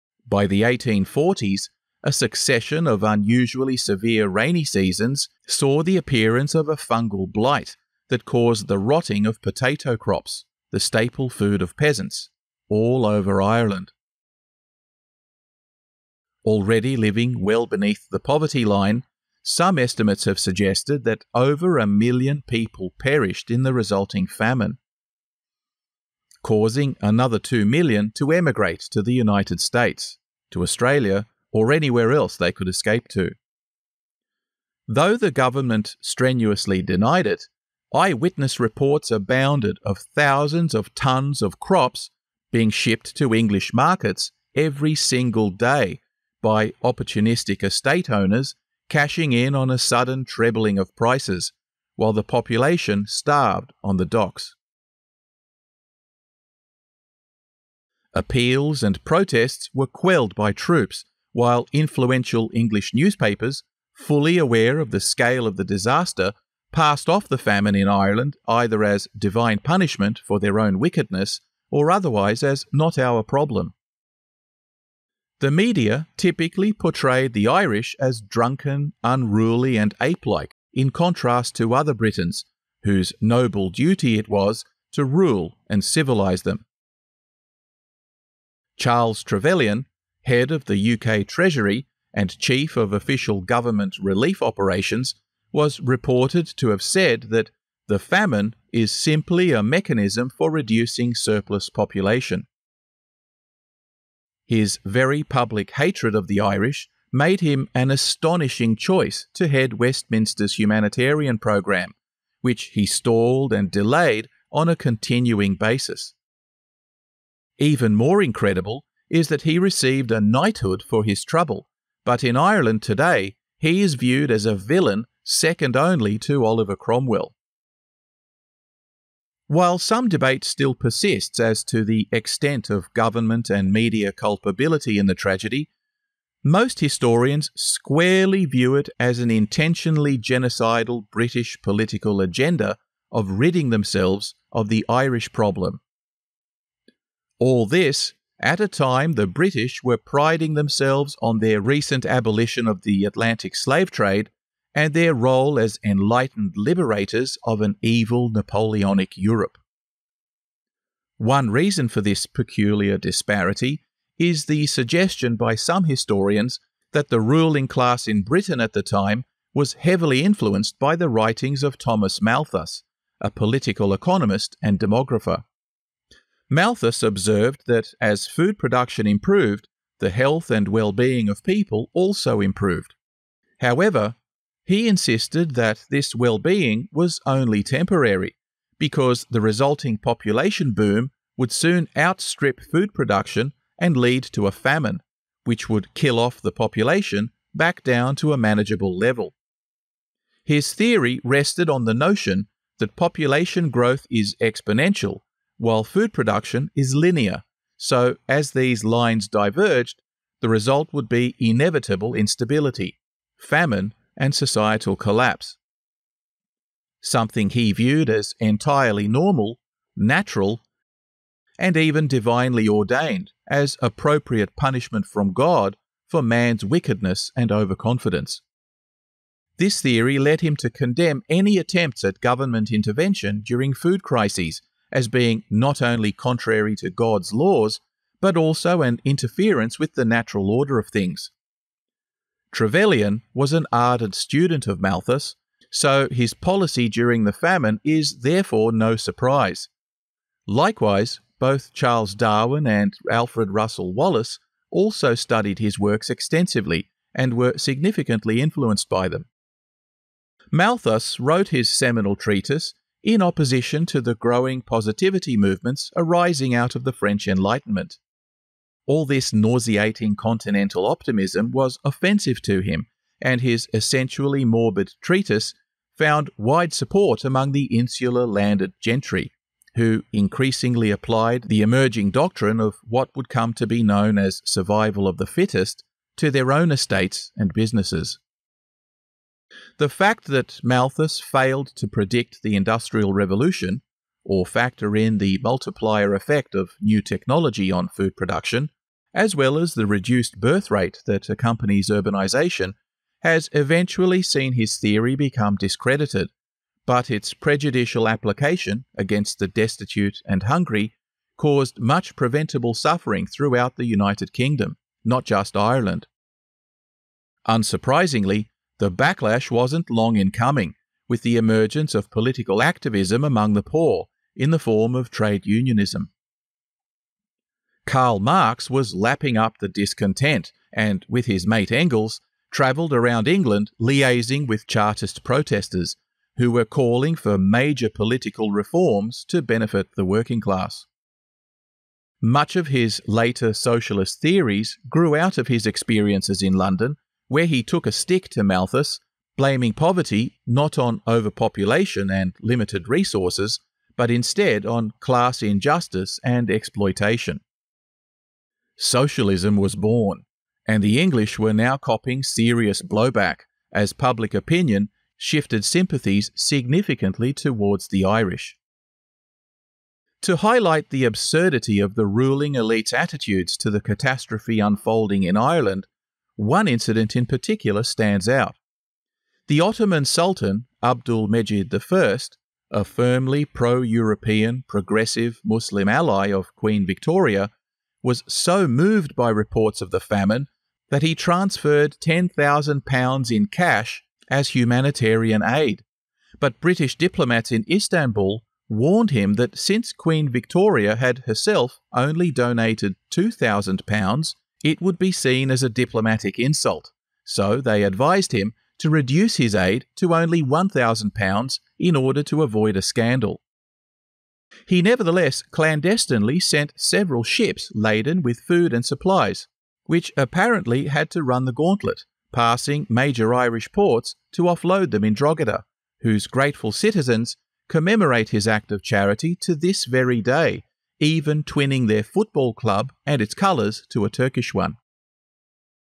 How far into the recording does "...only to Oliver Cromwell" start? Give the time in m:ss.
2:05.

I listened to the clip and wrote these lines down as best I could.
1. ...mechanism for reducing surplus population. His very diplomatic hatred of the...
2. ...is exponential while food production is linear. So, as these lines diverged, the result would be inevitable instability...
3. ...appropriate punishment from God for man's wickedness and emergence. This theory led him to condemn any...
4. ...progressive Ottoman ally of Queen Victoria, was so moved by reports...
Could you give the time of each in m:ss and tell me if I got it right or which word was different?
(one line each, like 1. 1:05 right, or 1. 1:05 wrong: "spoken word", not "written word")
1. 1:39 wrong: "public", not "diplomatic"
2. 3:24 right
3. 3:43 wrong: "overconfidence", not "emergence"
4. 6:24 wrong: "Muslim", not "Ottoman".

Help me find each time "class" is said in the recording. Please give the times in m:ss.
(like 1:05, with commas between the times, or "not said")
2:47, 5:40, 5:54.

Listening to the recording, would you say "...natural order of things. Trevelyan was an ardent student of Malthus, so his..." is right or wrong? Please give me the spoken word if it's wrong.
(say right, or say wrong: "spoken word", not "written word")
right.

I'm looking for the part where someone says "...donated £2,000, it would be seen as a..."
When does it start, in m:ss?
6:42.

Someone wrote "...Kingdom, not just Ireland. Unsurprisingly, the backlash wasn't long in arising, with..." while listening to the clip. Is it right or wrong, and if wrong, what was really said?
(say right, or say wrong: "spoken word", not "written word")
wrong: "coming", not "arising".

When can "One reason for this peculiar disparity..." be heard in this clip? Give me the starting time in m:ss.
2:41.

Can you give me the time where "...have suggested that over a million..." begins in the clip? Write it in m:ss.
0:20.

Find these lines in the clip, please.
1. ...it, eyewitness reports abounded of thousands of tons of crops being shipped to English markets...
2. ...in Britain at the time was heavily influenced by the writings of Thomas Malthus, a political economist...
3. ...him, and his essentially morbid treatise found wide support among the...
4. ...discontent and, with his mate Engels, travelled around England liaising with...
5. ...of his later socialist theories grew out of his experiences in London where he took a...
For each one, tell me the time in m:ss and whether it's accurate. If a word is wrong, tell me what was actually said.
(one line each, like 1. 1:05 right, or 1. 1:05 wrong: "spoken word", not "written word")
1. 0:37 right
2. 2:48 right
3. 4:32 right
4. 5:29 right
5. 5:42 right.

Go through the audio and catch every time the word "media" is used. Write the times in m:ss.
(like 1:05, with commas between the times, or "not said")
1:15, 2:13.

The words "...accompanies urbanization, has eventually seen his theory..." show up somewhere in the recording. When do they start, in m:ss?
5:01.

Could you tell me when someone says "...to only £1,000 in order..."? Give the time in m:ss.
6:49.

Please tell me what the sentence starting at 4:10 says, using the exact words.
Likewise, both Charles Darwin and Alfred Russel Wallace also studied his works extensively and were significantly influenced by them.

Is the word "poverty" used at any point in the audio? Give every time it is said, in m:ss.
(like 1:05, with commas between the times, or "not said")
0:18, 5:49.